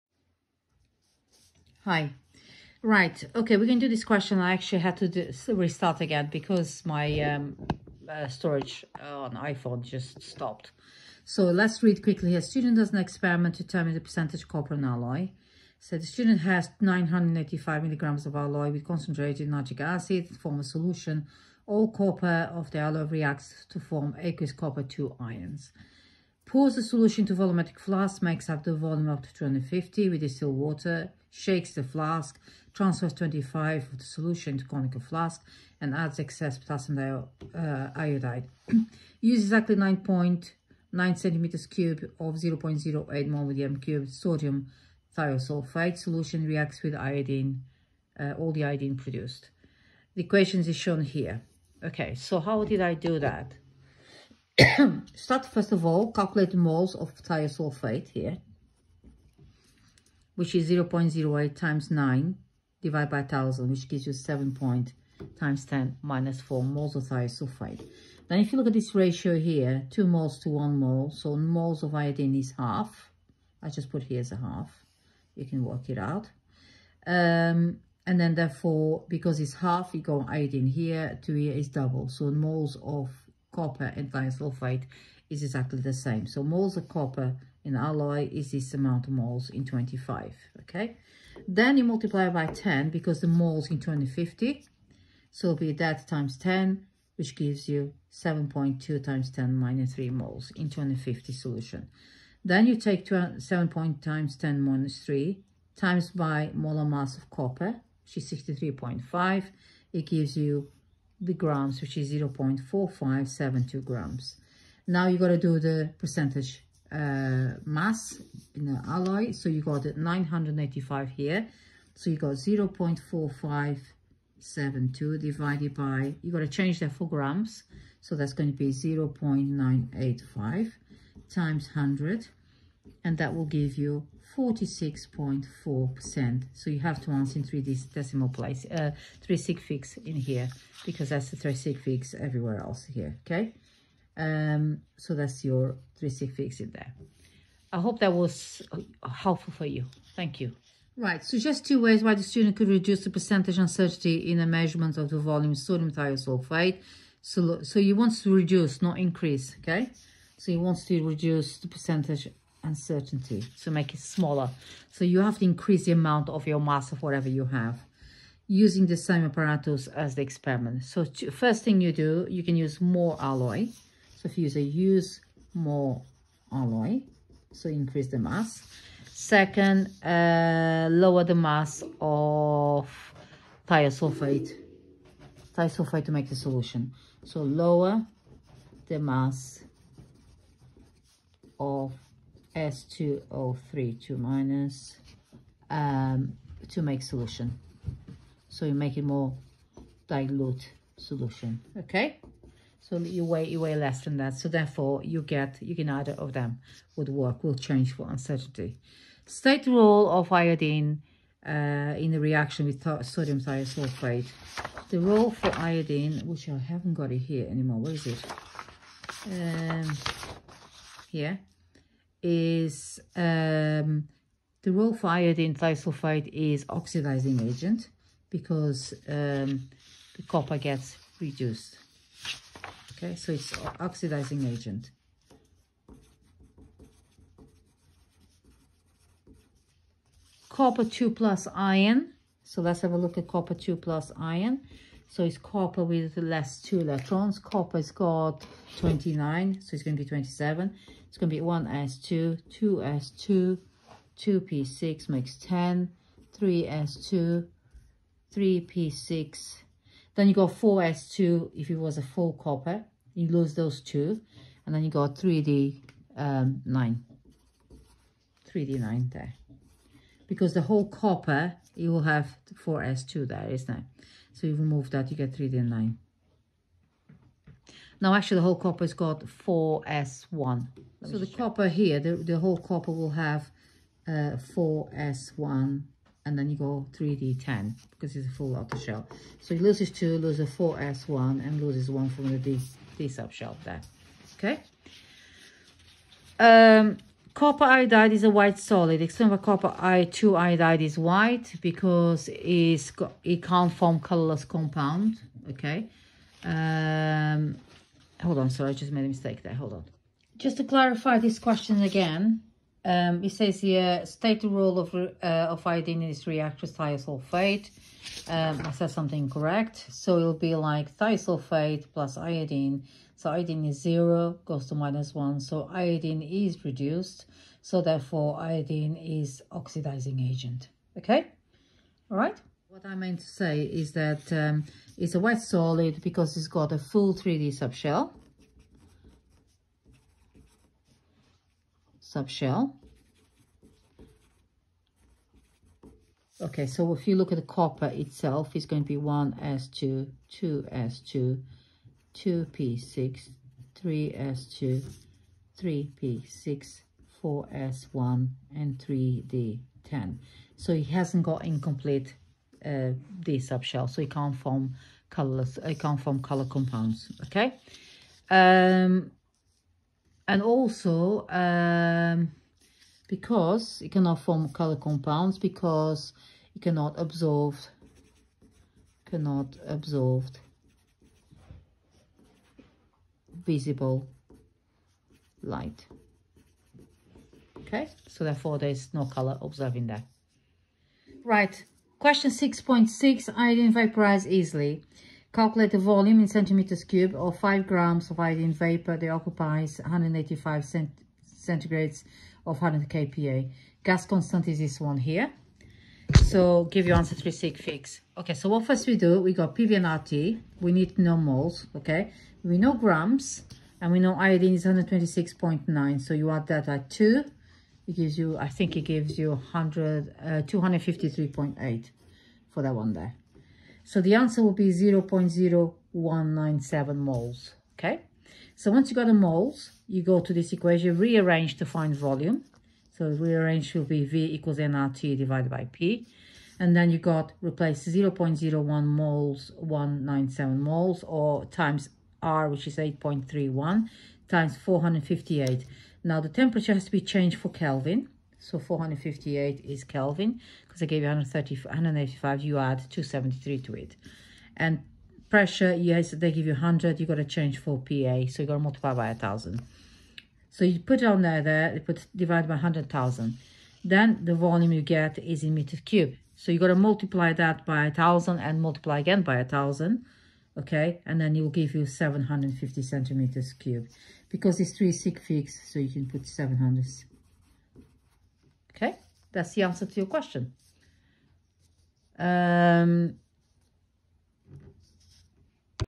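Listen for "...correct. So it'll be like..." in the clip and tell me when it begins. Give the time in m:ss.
5:19.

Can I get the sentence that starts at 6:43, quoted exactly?
Gas constant is this one here.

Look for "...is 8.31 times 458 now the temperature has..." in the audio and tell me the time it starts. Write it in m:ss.
7:22.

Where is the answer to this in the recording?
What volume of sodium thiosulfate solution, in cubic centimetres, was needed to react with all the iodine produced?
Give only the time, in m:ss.
0:39.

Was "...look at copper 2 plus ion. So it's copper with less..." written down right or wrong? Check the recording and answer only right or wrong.
right.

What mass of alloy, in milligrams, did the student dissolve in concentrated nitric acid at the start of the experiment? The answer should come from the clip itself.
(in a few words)
985.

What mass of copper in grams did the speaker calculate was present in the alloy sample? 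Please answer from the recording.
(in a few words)
0.4572 grams.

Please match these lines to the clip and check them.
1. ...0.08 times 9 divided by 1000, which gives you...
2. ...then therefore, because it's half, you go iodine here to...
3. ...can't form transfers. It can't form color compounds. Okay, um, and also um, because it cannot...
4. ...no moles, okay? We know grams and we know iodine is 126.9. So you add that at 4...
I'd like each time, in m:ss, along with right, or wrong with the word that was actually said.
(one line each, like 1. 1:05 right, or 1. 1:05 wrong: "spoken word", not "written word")
1. 1:00 right
2. 1:18 right
3. 6:04 wrong: "colors", not "transfers"
4. 6:50 wrong: "2", not "4".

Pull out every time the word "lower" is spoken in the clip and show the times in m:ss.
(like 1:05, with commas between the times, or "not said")
3:00, 3:07.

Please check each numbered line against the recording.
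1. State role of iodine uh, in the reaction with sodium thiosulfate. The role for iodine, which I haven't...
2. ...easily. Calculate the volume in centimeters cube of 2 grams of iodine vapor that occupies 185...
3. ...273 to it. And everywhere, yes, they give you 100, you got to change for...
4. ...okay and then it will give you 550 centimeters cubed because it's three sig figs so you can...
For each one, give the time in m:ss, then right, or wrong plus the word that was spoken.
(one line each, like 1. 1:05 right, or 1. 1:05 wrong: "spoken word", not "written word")
1. 3:29 right
2. 6:34 wrong: "5", not "2"
3. 7:32 wrong: "pressure", not "everywhere"
4. 7:50 wrong: "750", not "550".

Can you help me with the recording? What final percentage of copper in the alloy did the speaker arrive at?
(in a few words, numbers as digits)
46.4%.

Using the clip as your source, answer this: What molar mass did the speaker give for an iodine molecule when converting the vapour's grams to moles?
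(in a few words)
253.8.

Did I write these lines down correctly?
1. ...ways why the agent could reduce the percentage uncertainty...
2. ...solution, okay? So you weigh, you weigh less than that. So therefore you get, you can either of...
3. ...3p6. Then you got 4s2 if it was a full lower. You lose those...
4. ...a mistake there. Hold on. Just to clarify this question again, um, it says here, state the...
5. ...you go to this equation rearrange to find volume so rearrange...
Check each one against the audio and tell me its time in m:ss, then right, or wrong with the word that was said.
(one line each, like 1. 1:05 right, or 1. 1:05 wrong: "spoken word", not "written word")
1. 2:31 wrong: "student", not "agent"
2. 3:20 right
3. 4:18 wrong: "copper", not "lower"
4. 5:09 right
5. 7:09 right.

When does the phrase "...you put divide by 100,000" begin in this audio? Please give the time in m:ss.
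7:41.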